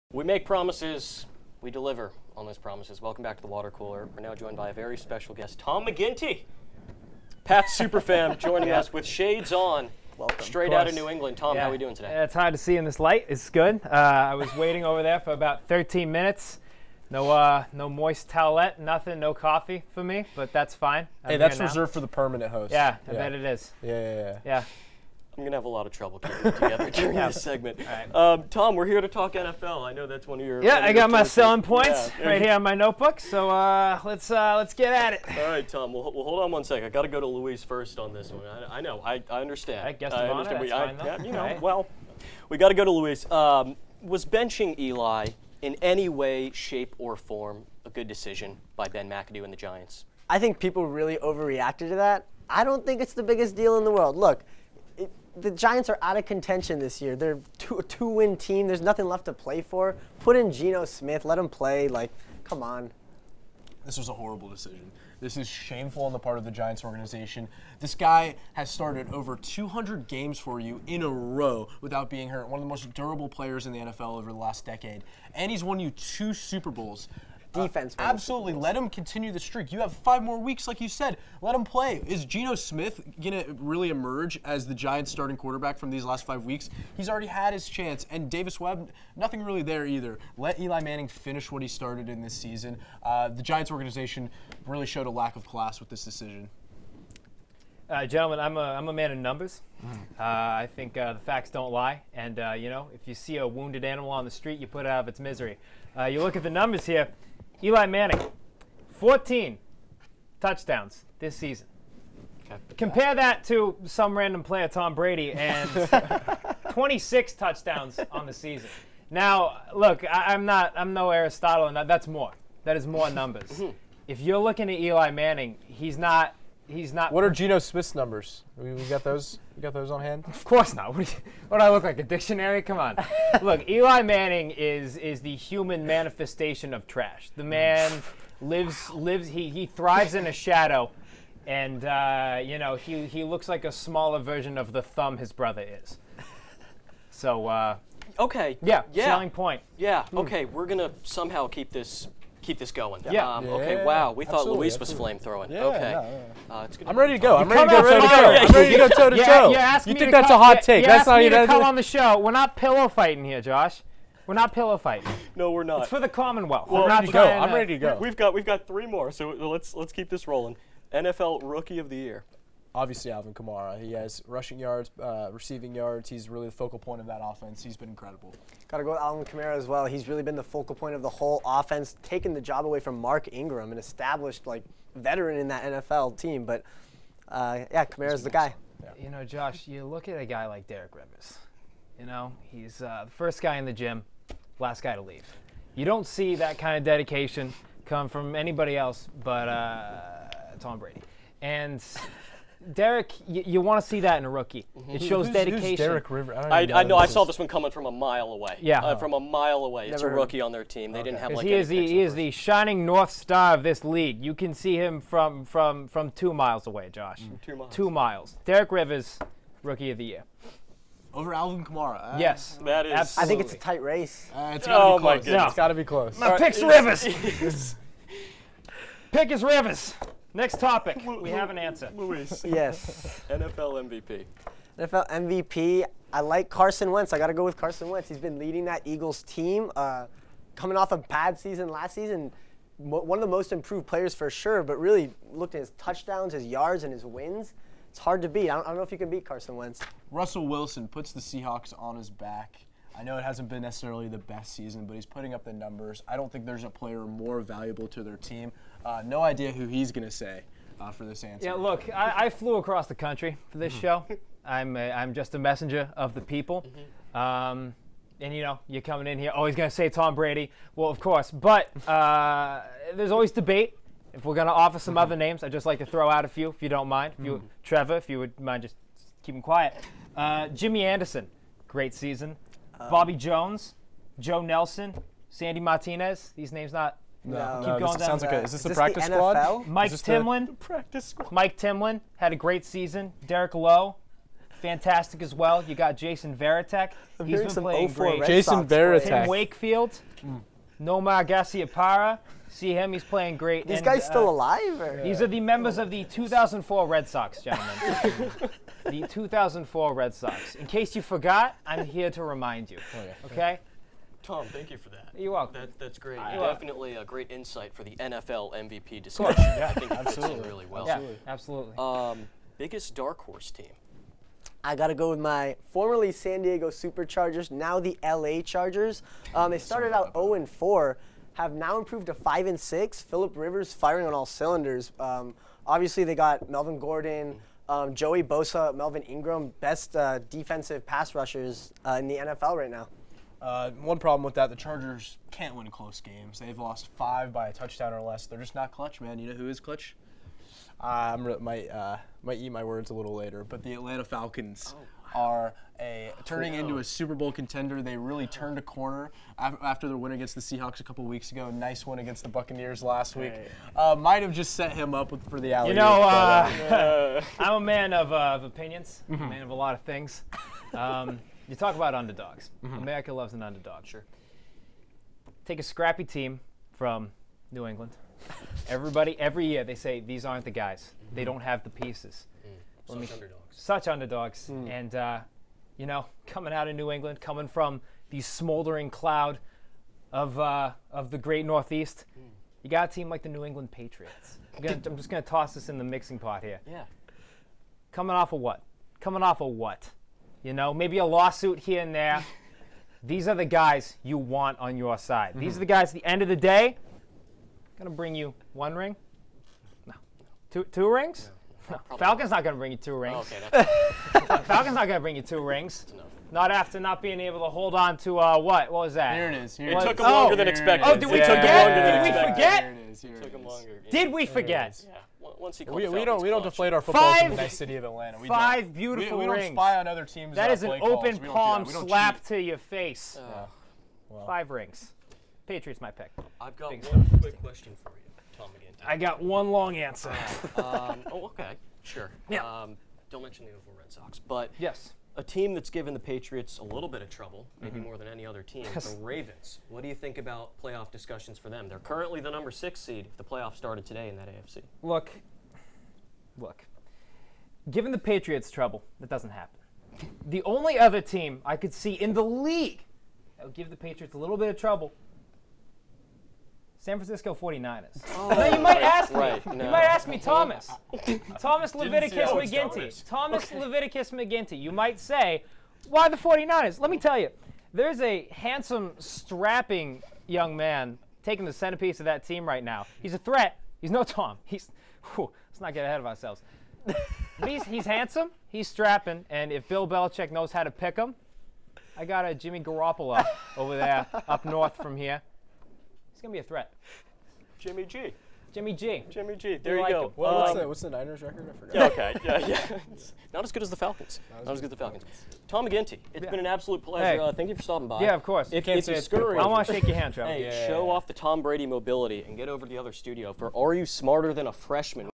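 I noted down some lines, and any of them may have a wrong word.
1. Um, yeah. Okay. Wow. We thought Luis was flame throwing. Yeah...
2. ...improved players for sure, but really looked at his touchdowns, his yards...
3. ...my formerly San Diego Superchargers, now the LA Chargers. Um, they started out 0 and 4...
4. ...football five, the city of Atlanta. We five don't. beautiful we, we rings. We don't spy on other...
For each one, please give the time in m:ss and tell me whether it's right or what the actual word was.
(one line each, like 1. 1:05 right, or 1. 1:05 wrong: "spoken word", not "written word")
1. 2:33 right
2. 4:03 right
3. 5:25 right
4. 7:06 right.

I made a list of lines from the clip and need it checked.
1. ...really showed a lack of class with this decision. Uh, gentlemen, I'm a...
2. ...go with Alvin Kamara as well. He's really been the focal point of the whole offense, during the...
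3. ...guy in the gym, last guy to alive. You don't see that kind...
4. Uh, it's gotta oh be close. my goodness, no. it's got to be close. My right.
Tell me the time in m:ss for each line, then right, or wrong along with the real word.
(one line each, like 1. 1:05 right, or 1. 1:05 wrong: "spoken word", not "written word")
1. 1:34 right
2. 2:58 wrong: "taking", not "during"
3. 3:13 wrong: "leave", not "alive"
4. 3:44 right.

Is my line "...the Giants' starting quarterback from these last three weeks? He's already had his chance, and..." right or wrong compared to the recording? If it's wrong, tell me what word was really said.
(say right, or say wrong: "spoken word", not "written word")
wrong: "five", not "three".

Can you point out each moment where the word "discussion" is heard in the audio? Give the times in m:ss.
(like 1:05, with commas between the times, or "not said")
5:19, 7:30.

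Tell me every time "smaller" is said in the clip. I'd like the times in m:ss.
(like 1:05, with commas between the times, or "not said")
2:23.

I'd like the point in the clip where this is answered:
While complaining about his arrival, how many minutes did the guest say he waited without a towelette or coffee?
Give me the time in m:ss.
0:15.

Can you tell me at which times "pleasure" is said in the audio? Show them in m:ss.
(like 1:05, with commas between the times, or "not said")
8:26.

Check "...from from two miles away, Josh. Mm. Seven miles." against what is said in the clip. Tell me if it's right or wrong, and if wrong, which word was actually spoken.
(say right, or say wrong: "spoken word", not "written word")
wrong: "Two", not "Seven".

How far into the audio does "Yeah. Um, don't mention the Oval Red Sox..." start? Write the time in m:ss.
7:22.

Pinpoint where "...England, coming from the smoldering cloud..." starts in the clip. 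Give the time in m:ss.
6:26.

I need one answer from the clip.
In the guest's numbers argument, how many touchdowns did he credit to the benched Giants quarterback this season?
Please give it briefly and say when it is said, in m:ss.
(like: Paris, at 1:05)
14, at 1:48.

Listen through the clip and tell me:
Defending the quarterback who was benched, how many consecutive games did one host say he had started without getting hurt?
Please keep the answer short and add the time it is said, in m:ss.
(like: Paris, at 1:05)
over 200, at 1:09.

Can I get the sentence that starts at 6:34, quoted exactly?
I'm, gonna, I'm just going to toss this in the mixing pot here.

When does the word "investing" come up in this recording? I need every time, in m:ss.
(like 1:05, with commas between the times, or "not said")
not said.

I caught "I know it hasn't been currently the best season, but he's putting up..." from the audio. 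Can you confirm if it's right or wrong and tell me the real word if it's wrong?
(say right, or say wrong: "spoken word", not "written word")
wrong: "necessarily", not "currently".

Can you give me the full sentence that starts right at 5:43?
Uh, one problem with that, the Chargers can't win close games.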